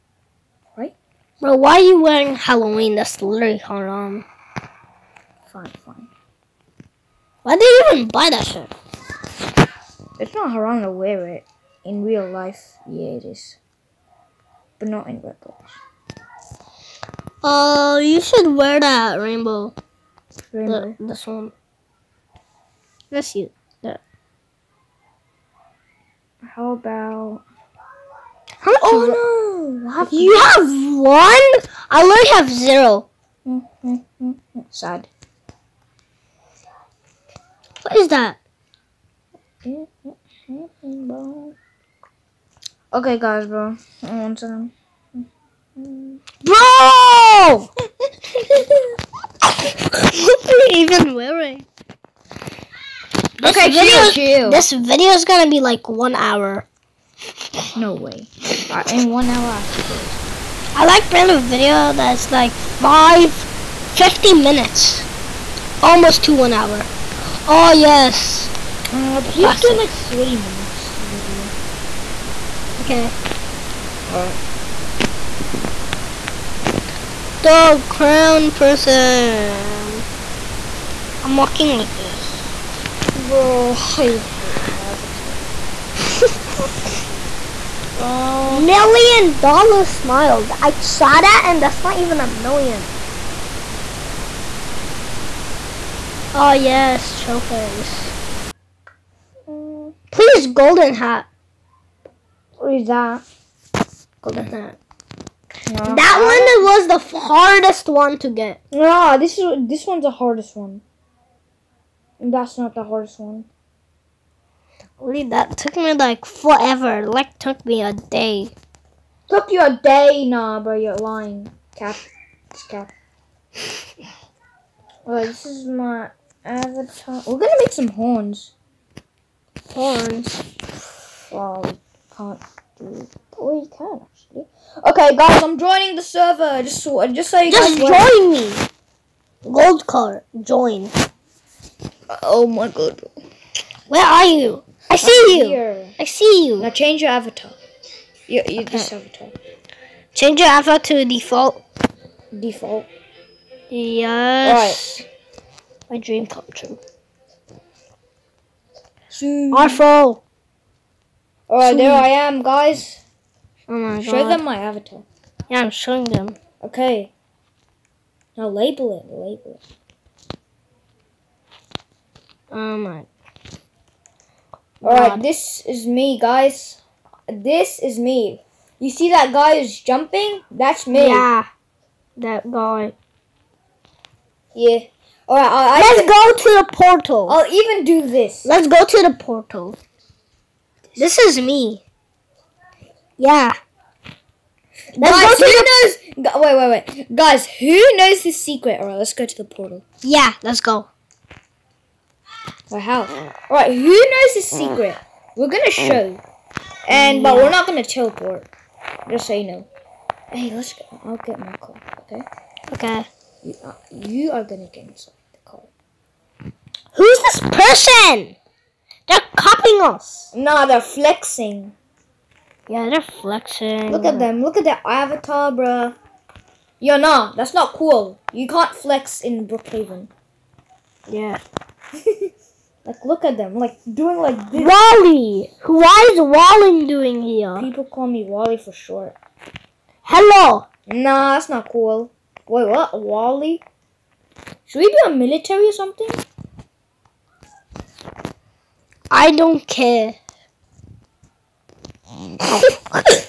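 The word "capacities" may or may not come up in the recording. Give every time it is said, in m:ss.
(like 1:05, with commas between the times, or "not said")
not said.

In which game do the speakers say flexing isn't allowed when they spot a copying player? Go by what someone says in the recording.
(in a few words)
Brookhaven.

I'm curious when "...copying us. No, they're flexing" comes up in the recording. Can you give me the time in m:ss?
3:39.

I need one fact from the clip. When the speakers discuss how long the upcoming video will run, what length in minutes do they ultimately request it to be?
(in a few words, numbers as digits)
40 minutes.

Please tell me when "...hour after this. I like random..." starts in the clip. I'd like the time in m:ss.
0:59.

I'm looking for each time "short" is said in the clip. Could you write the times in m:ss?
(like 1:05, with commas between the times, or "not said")
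3:58.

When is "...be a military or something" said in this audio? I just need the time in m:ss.
4:04.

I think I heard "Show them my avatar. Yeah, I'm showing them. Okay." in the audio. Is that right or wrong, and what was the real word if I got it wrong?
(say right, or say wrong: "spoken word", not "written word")
right.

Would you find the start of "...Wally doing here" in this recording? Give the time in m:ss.
3:56.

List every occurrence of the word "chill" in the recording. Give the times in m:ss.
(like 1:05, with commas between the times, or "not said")
1:37.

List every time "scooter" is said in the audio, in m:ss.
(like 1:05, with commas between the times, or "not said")
not said.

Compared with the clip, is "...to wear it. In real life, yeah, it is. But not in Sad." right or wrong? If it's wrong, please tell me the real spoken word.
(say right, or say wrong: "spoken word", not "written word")
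wrong: "Roblox", not "Sad".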